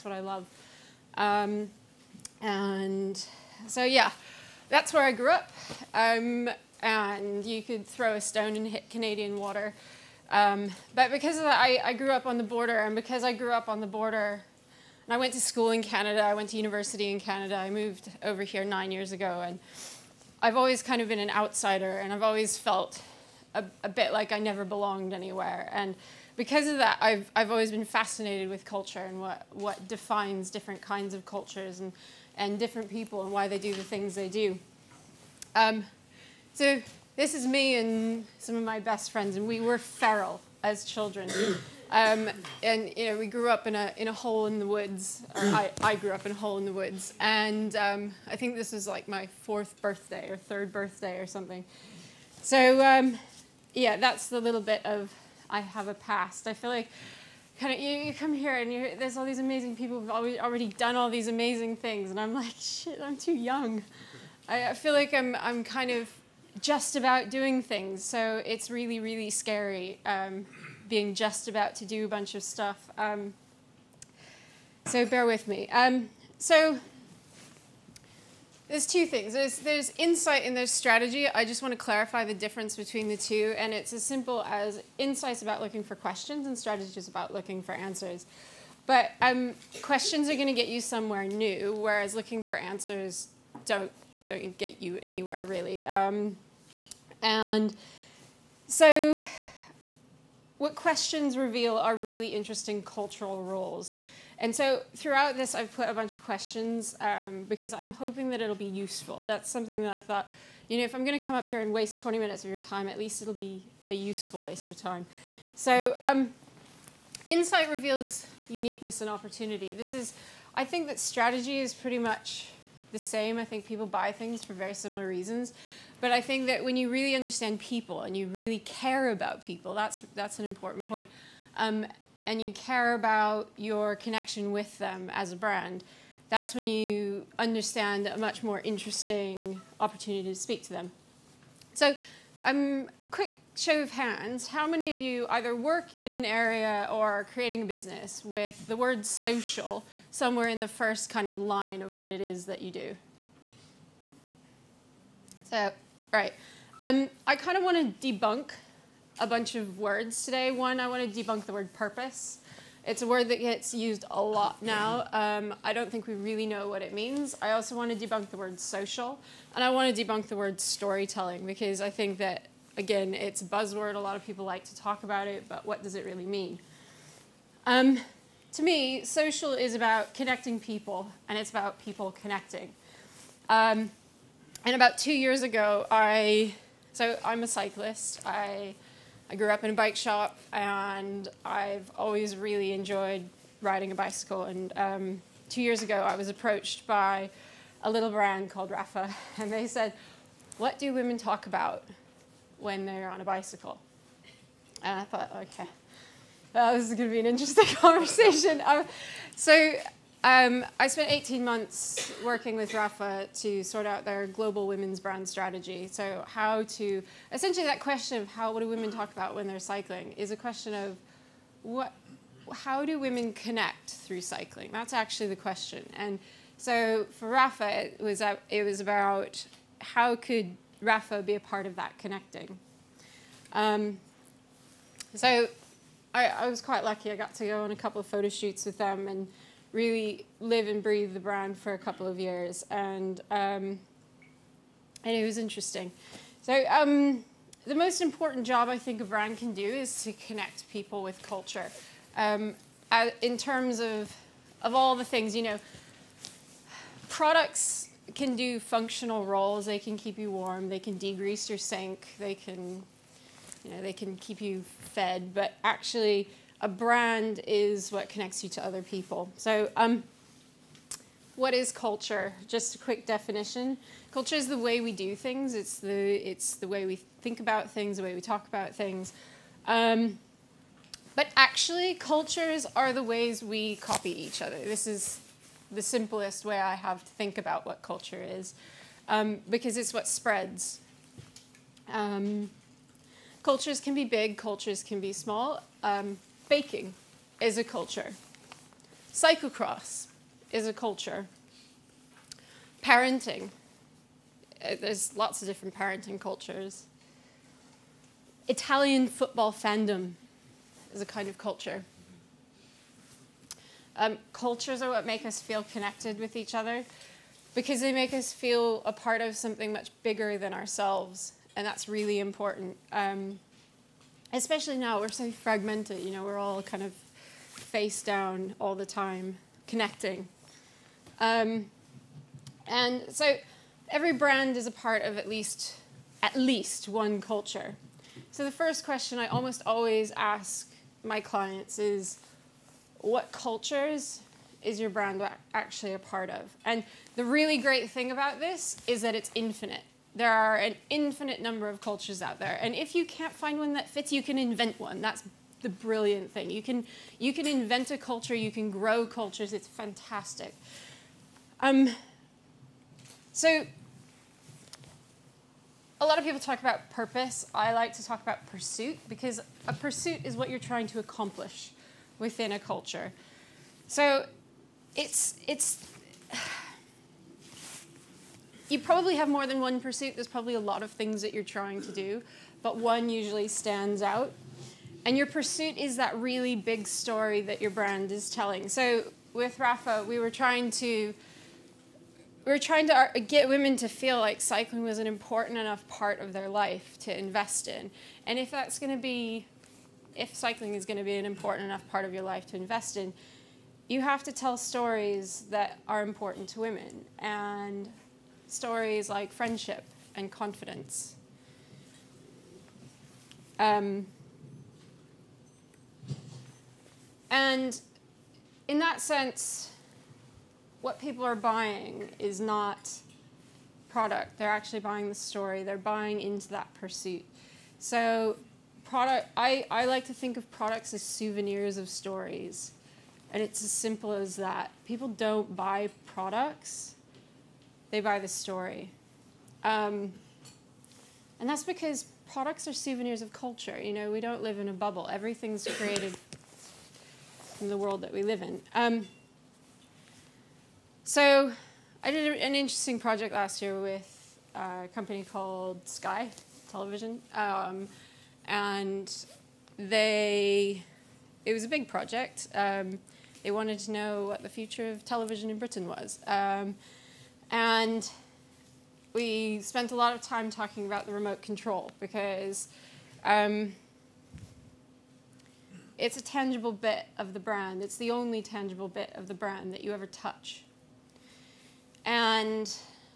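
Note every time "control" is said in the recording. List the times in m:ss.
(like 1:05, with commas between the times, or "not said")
7:51.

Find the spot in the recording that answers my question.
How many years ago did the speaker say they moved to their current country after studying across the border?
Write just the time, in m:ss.
0:18.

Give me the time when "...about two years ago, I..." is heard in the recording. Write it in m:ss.
3:04.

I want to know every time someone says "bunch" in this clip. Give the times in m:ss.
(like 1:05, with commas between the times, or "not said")
1:12, 1:45, 2:39.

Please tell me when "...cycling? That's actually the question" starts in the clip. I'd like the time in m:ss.
3:44.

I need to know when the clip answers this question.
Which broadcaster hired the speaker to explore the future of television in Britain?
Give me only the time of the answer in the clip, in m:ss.
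7:35.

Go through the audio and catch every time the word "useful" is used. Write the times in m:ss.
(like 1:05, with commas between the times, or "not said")
1:48, 1:53.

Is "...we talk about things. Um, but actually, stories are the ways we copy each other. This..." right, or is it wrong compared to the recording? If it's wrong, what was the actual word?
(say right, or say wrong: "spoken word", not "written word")
wrong: "cultures", not "stories".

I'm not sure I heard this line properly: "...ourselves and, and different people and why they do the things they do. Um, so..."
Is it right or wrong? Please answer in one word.
wrong.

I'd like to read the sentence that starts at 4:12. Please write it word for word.
Um, in terms of of all the things, you know, products can do functional roles.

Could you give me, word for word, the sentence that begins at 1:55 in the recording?
So, um, insight reveals uniqueness and opportunity.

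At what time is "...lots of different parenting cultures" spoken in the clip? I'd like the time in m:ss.
5:05.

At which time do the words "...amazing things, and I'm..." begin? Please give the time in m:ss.
1:01.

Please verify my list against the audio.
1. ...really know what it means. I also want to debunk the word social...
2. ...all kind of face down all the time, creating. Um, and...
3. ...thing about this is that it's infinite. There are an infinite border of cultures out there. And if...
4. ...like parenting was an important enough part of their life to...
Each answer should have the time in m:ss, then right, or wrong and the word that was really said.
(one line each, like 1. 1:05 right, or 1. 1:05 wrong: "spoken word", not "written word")
1. 2:46 right
2. 5:26 wrong: "connecting", not "creating"
3. 5:47 wrong: "number", not "border"
4. 6:34 wrong: "cycling", not "parenting".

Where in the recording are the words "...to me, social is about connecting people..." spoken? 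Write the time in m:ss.
2:58.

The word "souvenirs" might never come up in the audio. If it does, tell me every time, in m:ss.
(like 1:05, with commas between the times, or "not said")
7:11, 7:22.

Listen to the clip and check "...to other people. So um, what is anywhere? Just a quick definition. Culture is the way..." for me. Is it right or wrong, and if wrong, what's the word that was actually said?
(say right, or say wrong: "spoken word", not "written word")
wrong: "culture", not "anywhere".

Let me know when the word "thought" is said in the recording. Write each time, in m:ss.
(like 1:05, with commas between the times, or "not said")
1:50, 3:25.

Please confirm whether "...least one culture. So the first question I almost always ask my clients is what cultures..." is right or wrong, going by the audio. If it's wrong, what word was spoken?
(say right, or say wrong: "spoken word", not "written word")
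right.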